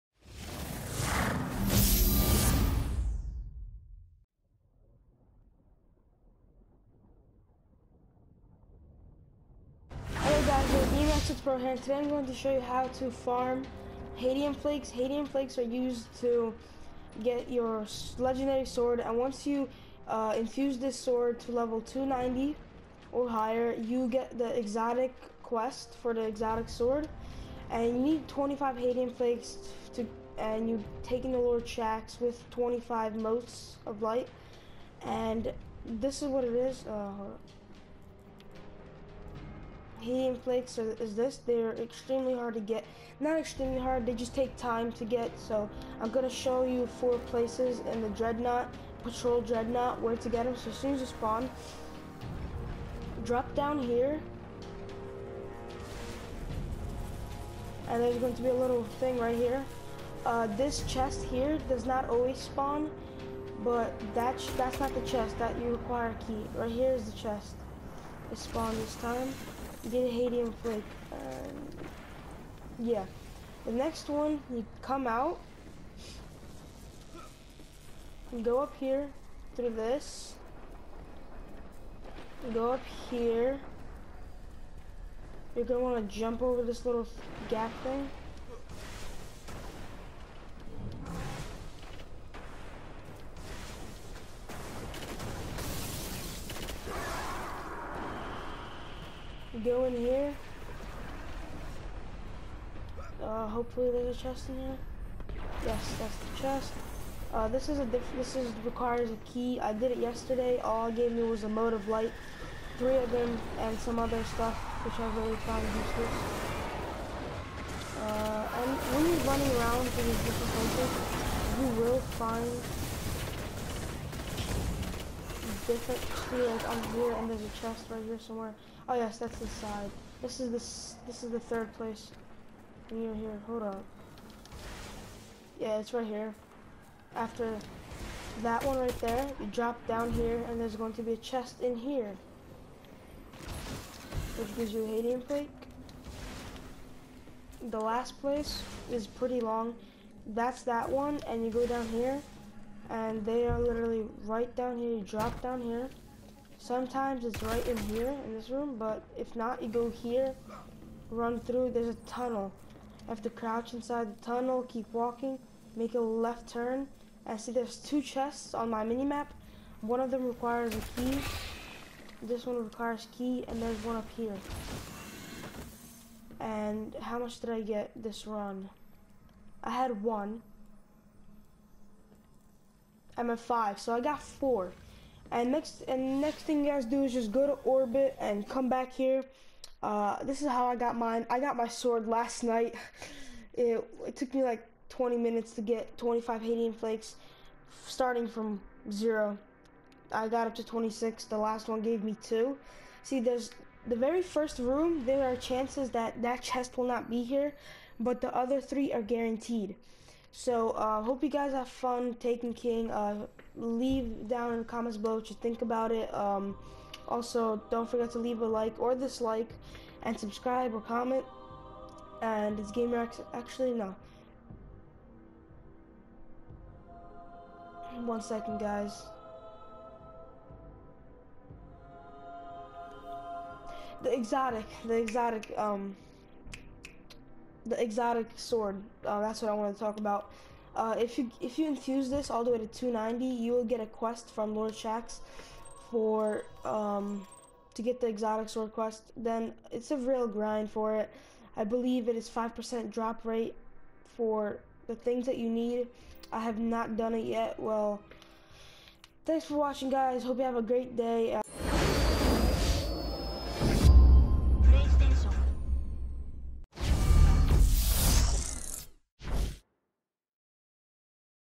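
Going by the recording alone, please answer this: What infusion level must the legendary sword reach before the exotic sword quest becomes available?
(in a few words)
290.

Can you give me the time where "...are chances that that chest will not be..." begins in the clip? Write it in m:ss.
3:25.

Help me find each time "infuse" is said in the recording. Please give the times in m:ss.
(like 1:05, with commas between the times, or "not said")
0:20, 4:01.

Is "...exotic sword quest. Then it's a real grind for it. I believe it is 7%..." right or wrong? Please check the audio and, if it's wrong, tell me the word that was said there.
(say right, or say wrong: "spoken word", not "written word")
wrong: "5", not "7".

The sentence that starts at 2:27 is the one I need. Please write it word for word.
The last place is pretty long.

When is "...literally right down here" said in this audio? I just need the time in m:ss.
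2:33.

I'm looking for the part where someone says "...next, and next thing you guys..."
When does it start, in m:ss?
3:05.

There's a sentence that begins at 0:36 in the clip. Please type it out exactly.
Uh, Hadium flakes are, is this.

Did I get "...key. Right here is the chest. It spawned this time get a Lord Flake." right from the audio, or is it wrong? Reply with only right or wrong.
wrong.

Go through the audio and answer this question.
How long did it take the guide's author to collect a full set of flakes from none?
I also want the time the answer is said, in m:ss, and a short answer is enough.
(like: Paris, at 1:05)
20 minutes, at 3:14.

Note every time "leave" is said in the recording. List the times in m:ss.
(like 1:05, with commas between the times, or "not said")
3:33, 3:38.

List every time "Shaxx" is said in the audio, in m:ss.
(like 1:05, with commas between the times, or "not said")
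0:31, 4:04.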